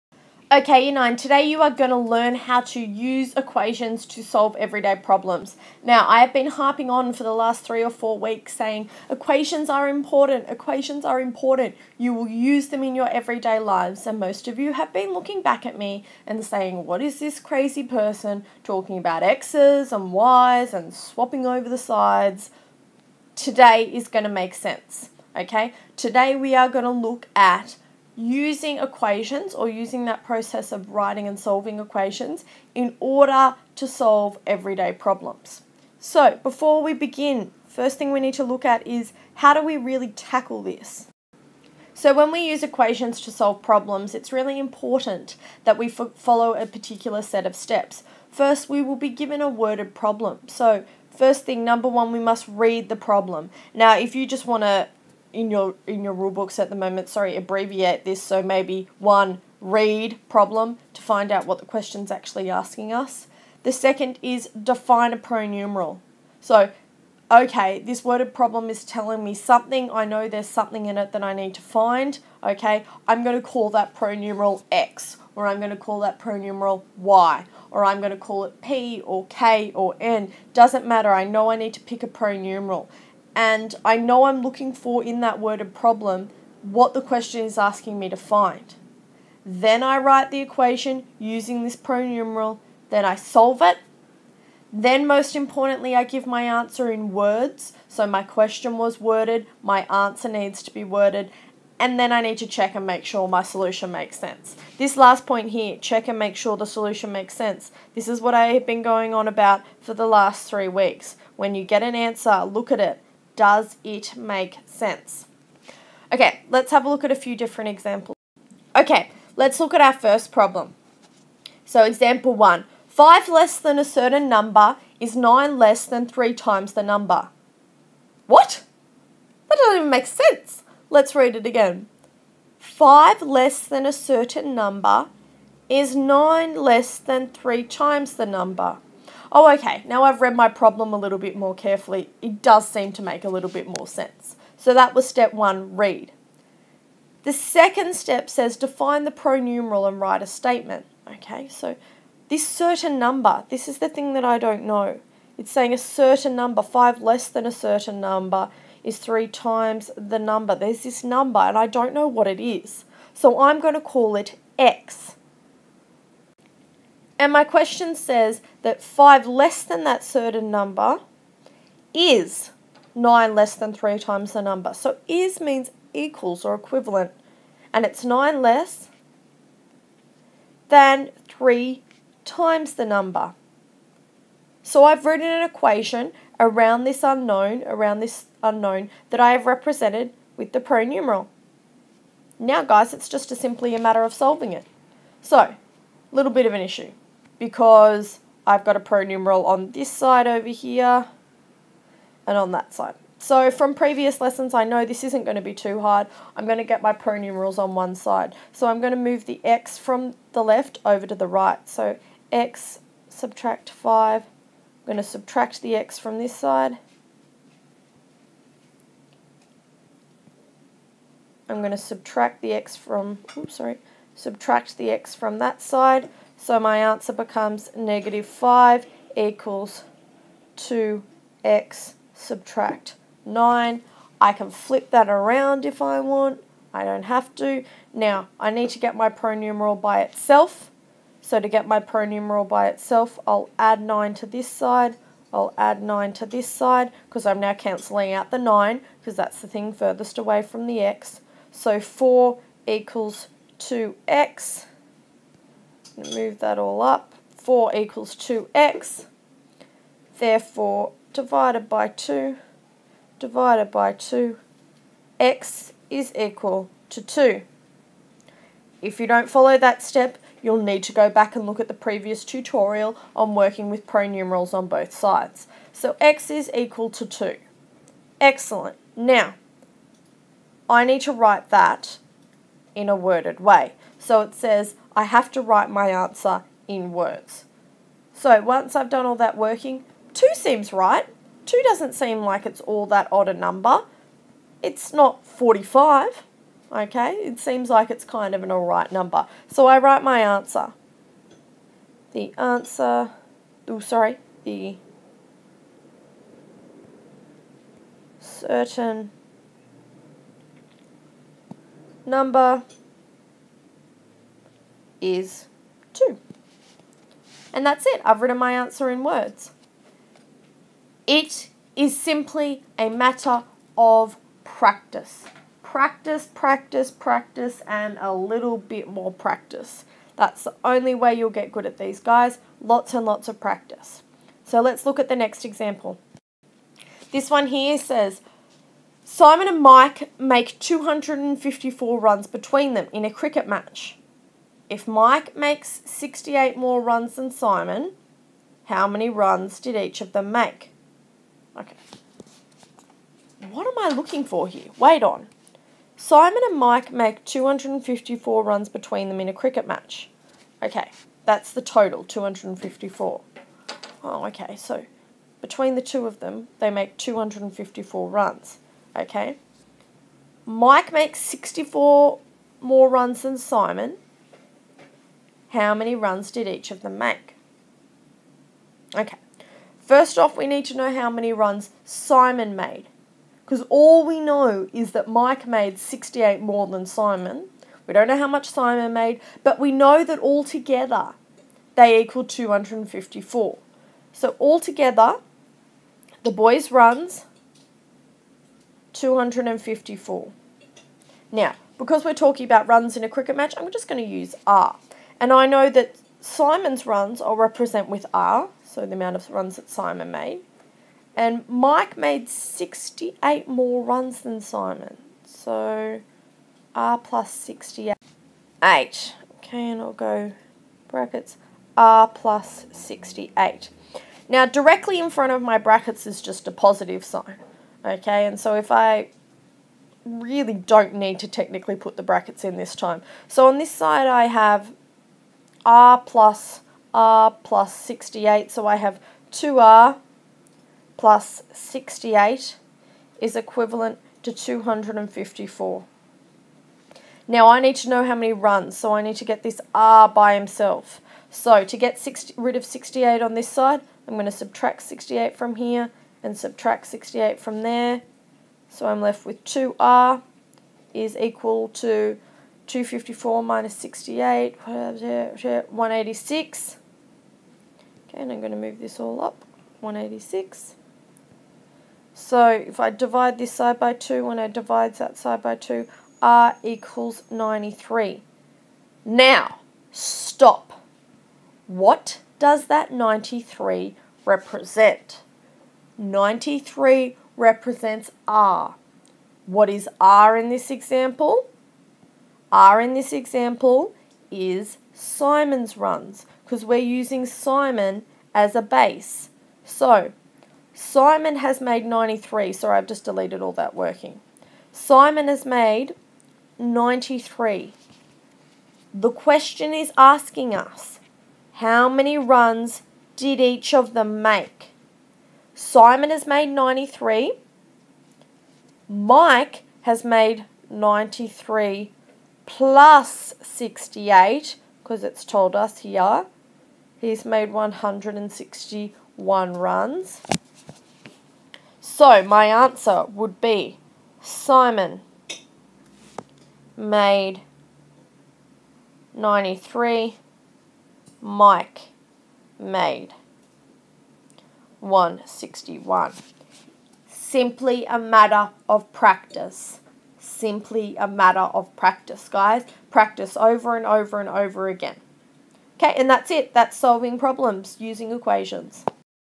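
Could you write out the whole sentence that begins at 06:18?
Okay, first off, we need to know how many runs Simon made.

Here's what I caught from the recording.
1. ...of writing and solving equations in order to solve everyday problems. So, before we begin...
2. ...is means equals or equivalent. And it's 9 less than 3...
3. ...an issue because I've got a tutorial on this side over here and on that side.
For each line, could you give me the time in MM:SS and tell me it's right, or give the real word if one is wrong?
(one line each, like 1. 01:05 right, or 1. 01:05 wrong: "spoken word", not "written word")
1. 00:30 right
2. 02:55 right
3. 03:16 wrong: "pronumeral", not "tutorial".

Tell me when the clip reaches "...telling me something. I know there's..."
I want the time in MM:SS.
01:08.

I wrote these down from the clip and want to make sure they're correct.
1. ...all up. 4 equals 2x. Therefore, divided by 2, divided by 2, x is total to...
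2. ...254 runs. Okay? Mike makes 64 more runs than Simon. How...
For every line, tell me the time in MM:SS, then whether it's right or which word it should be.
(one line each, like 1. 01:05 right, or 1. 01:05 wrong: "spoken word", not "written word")
1. 04:16 wrong: "equal", not "total"
2. 06:06 right.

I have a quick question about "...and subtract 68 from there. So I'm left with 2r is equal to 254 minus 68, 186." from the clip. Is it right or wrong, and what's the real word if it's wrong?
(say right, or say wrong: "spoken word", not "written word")
right.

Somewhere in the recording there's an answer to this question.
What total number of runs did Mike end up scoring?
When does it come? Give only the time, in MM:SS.
08:47.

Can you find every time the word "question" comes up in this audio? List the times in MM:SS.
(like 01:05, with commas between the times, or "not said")
01:01, 01:27, 01:38, 02:47, 08:29.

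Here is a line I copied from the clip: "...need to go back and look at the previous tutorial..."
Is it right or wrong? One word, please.
right.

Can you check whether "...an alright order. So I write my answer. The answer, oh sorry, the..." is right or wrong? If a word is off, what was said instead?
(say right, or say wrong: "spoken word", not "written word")
wrong: "number", not "order".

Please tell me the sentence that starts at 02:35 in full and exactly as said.
It's saying a certain number, five less than a certain number is three times the number.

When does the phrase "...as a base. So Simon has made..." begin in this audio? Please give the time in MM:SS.
08:18.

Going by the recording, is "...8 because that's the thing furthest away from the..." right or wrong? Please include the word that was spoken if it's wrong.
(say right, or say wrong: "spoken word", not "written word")
wrong: "9", not "8".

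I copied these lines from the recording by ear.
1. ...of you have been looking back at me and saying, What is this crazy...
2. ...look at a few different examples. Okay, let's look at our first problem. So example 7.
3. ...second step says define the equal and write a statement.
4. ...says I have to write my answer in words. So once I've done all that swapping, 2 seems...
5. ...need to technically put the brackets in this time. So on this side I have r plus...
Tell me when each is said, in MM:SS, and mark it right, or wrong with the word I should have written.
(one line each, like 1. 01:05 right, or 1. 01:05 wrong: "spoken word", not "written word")
1. 00:14 right
2. 01:56 wrong: "1", not "7"
3. 02:27 wrong: "pronumeral", not "equal"
4. 04:44 wrong: "working", not "swapping"
5. 07:10 right.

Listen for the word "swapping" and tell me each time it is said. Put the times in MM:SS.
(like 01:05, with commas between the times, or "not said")
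00:20.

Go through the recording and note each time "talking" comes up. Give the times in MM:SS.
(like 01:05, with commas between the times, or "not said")
00:18, 06:42.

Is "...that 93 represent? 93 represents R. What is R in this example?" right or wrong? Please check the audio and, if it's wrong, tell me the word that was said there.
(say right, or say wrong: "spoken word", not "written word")
right.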